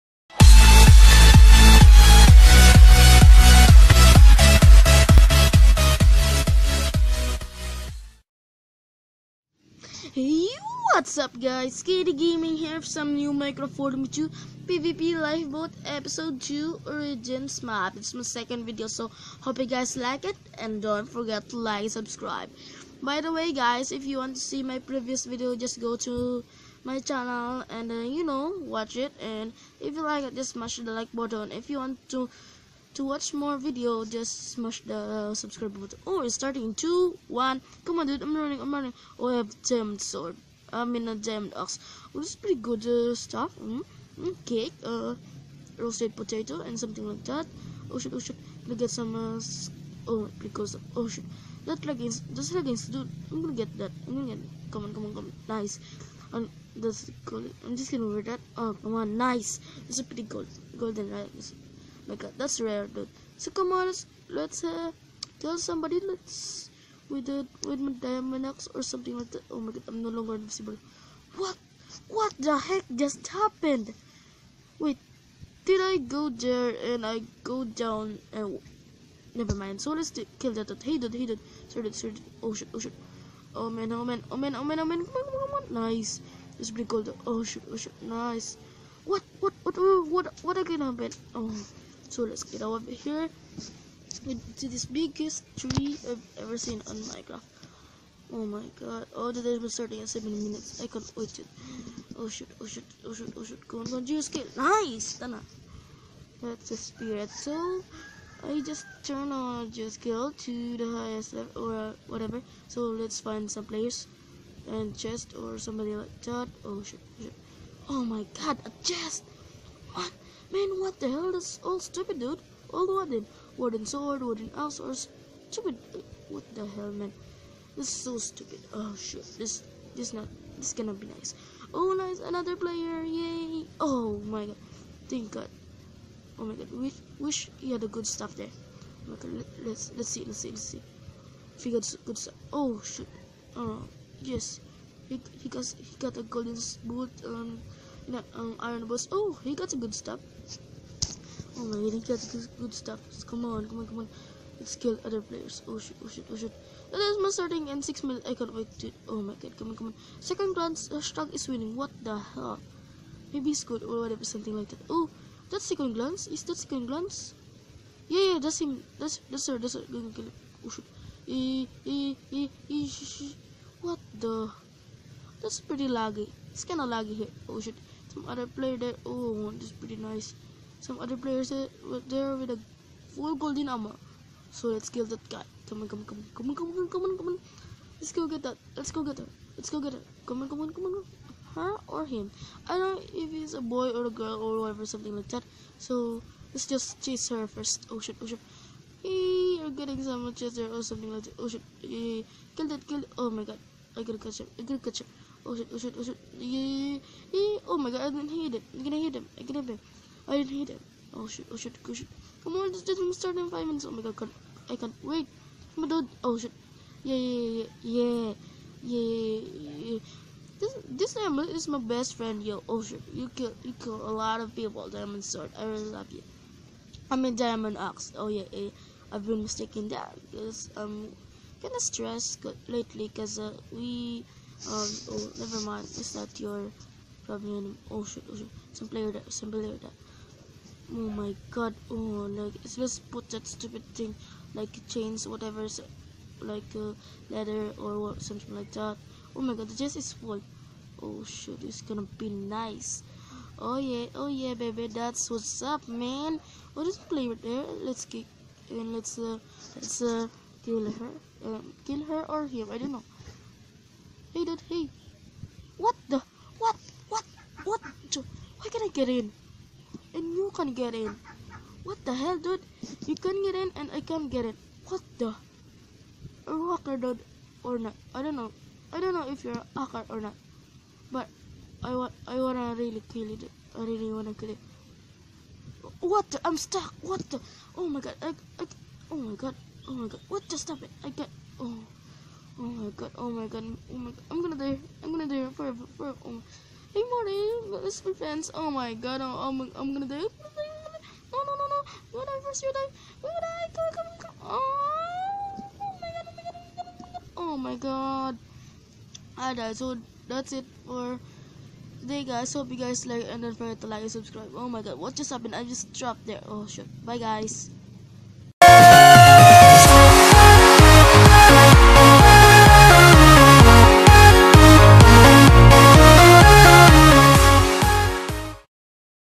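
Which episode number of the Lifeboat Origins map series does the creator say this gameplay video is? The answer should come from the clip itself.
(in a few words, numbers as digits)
Episode 2.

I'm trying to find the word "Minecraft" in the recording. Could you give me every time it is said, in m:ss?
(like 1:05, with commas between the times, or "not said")
0:13, 1:37.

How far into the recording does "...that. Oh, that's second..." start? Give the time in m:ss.
2:44.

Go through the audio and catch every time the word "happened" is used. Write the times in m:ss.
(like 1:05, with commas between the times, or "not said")
1:13, 1:30, 5:15.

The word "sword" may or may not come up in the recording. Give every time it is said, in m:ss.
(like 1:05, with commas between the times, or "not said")
0:40, 2:03, 3:45.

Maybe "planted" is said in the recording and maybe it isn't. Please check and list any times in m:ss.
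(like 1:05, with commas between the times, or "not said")
not said.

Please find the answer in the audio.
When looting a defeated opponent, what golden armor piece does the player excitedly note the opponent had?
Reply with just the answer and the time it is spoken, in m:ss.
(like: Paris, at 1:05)
Golden boot, at 2:26.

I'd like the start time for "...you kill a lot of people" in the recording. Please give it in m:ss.
3:43.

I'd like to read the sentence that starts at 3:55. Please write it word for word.
Is that your probably Oh shit, oh shit.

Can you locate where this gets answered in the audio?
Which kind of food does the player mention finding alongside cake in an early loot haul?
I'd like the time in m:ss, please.
0:45.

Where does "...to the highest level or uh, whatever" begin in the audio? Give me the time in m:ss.
1:50.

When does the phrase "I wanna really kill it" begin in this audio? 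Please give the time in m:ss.
4:42.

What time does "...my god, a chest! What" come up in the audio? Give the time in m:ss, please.
1:58.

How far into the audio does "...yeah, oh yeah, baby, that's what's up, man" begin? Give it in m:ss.
4:13.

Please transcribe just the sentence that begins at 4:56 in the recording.
Hey Marty, this is my fans.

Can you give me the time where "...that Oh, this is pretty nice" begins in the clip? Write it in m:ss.
2:58.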